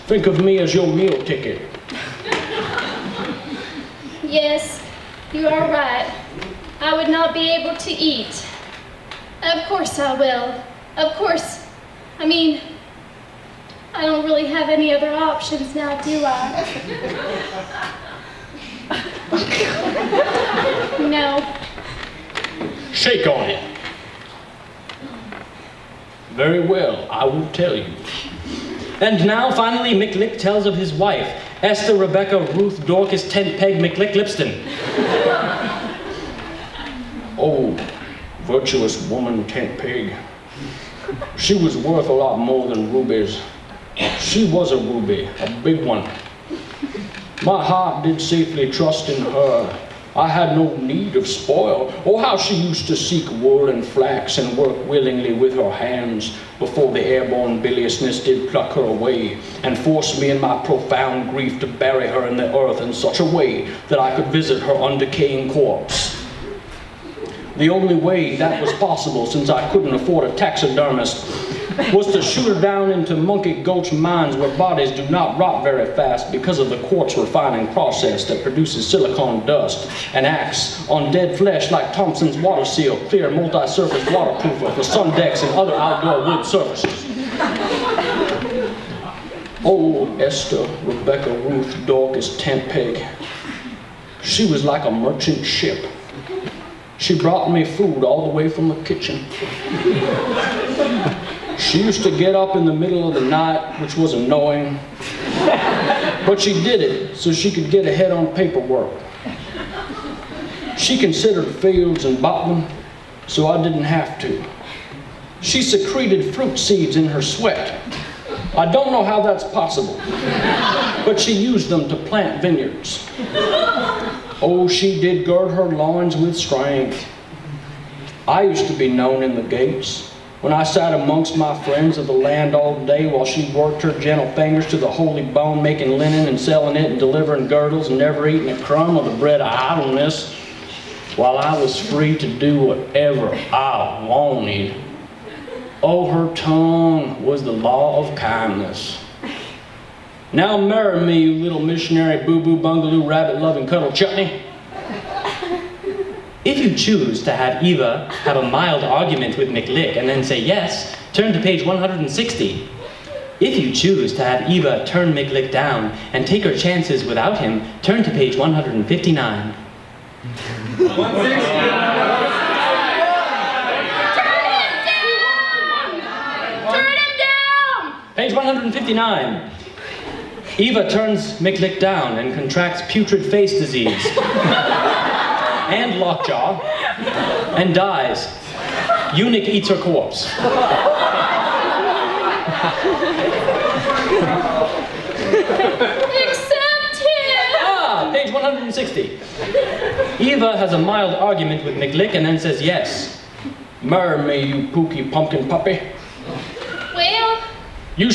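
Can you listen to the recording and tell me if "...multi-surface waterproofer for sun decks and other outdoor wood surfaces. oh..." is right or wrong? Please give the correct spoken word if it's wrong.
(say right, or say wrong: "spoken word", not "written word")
right.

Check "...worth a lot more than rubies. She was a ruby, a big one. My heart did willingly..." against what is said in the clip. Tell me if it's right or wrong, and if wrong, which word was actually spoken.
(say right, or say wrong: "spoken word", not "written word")
wrong: "safely", not "willingly".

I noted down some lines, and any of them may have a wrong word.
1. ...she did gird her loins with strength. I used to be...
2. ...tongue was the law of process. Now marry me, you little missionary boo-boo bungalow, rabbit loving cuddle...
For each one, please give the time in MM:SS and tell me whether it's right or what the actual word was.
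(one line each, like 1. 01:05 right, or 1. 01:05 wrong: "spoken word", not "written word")
1. 02:04 right
2. 02:26 wrong: "kindness", not "process".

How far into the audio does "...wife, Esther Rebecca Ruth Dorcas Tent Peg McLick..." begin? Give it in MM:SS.
00:30.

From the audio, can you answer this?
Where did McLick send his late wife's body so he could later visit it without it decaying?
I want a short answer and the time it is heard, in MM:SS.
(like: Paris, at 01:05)
Monkey Gulch mines, at 01:13.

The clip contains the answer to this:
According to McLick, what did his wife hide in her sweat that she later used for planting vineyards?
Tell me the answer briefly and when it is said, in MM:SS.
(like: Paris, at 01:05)
Fruit seeds, at 01:56.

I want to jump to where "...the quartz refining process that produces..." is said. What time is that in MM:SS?
01:16.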